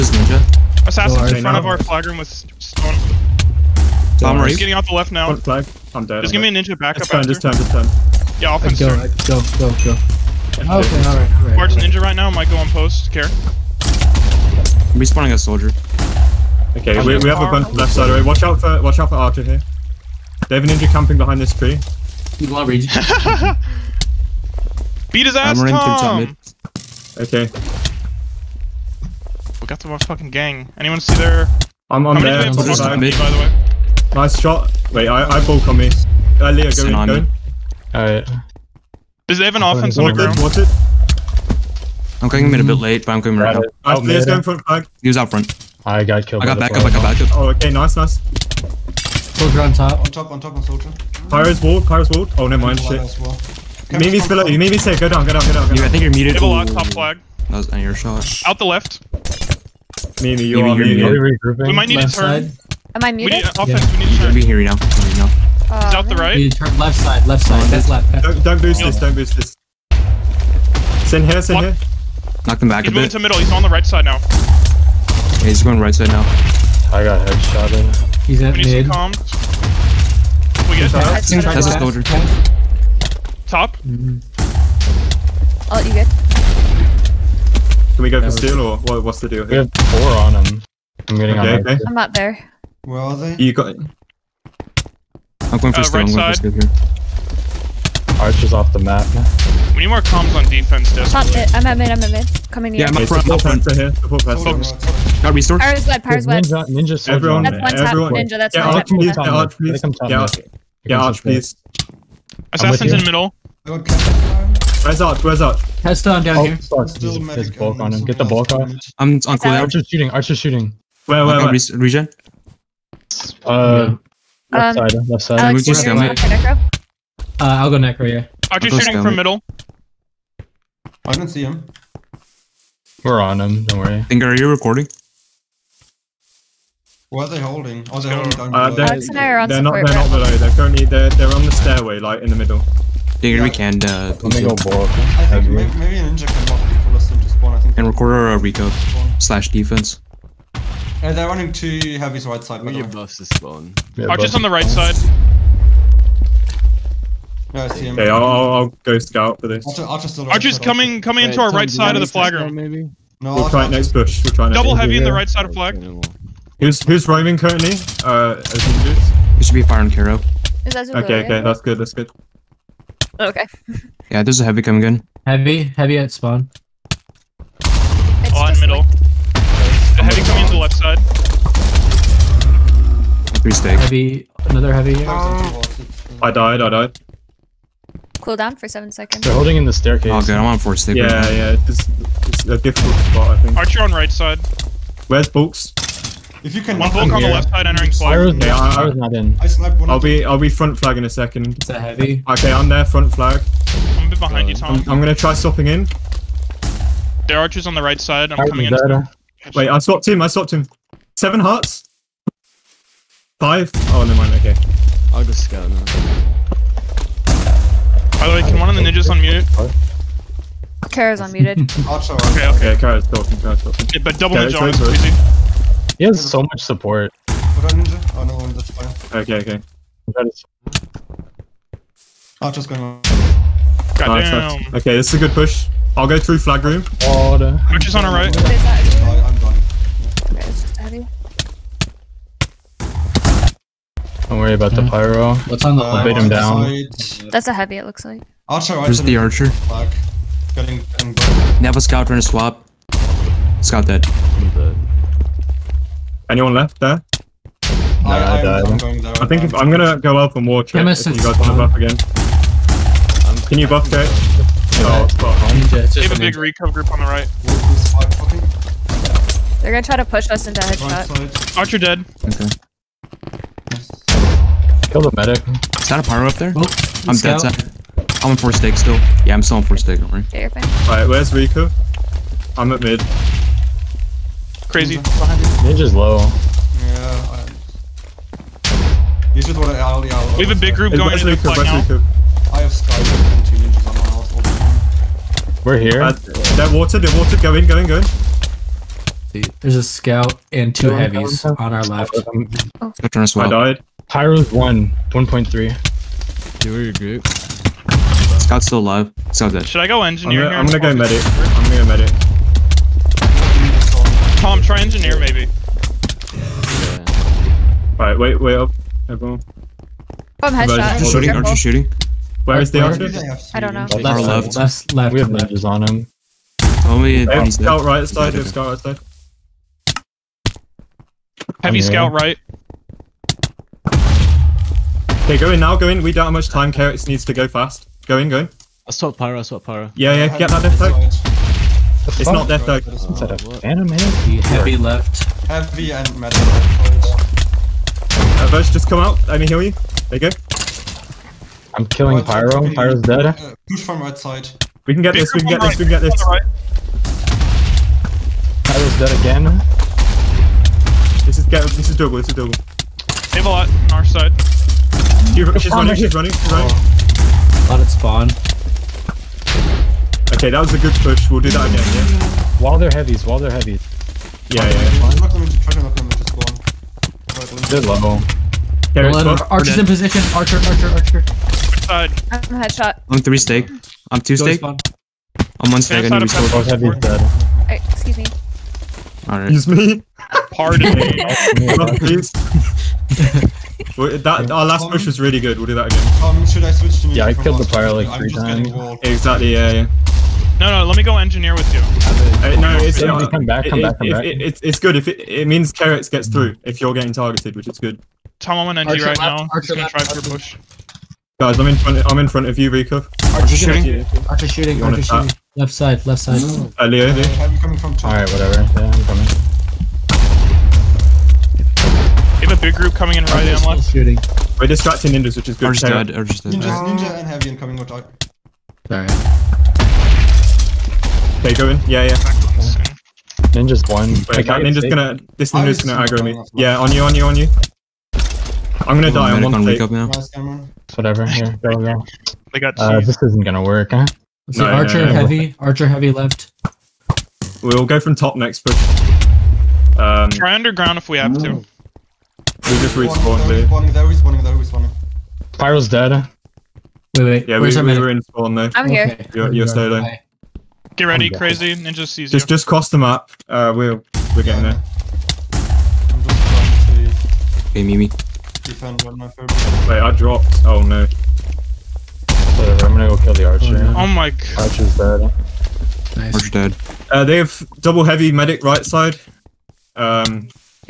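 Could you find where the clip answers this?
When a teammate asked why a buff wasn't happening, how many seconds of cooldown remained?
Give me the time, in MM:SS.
03:08.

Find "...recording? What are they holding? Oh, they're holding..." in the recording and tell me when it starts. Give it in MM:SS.
02:14.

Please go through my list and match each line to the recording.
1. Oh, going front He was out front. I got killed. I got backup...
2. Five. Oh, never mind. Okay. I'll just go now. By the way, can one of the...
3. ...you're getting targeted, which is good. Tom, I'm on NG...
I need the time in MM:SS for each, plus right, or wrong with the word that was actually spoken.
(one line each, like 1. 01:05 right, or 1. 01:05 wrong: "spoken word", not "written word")
1. 00:44 right
2. 03:33 right
3. 06:46 right.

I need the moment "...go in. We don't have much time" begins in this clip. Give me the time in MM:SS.
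05:35.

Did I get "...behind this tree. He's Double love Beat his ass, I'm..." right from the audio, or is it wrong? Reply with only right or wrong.
wrong.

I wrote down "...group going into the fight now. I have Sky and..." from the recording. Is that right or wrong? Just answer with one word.
right.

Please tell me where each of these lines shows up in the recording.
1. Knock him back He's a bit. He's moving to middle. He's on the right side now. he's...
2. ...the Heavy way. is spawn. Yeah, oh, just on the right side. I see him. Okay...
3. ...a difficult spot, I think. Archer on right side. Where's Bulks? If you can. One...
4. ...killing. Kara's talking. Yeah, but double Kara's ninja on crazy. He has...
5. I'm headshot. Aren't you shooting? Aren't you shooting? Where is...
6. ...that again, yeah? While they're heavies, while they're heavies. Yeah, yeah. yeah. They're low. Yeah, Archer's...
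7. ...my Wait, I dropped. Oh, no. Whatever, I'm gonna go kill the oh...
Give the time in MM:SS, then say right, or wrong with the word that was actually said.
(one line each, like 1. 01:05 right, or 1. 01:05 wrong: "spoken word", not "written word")
1. 01:12 right
2. 02:32 wrong: "Your", not "Heavy"
3. 03:12 right
4. 03:43 wrong: "talking", not "killing"
5. 05:20 right
6. 06:11 right
7. 07:49 right.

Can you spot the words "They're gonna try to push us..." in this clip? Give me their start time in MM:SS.
04:29.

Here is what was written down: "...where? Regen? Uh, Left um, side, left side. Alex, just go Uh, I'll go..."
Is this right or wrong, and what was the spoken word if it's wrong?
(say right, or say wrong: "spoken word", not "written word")
right.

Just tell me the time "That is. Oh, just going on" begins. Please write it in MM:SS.
03:50.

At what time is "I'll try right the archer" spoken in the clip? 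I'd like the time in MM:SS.
04:08.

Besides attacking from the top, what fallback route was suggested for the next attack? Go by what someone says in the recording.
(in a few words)
underground.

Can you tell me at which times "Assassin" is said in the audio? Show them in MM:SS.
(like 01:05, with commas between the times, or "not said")
00:00, 01:52.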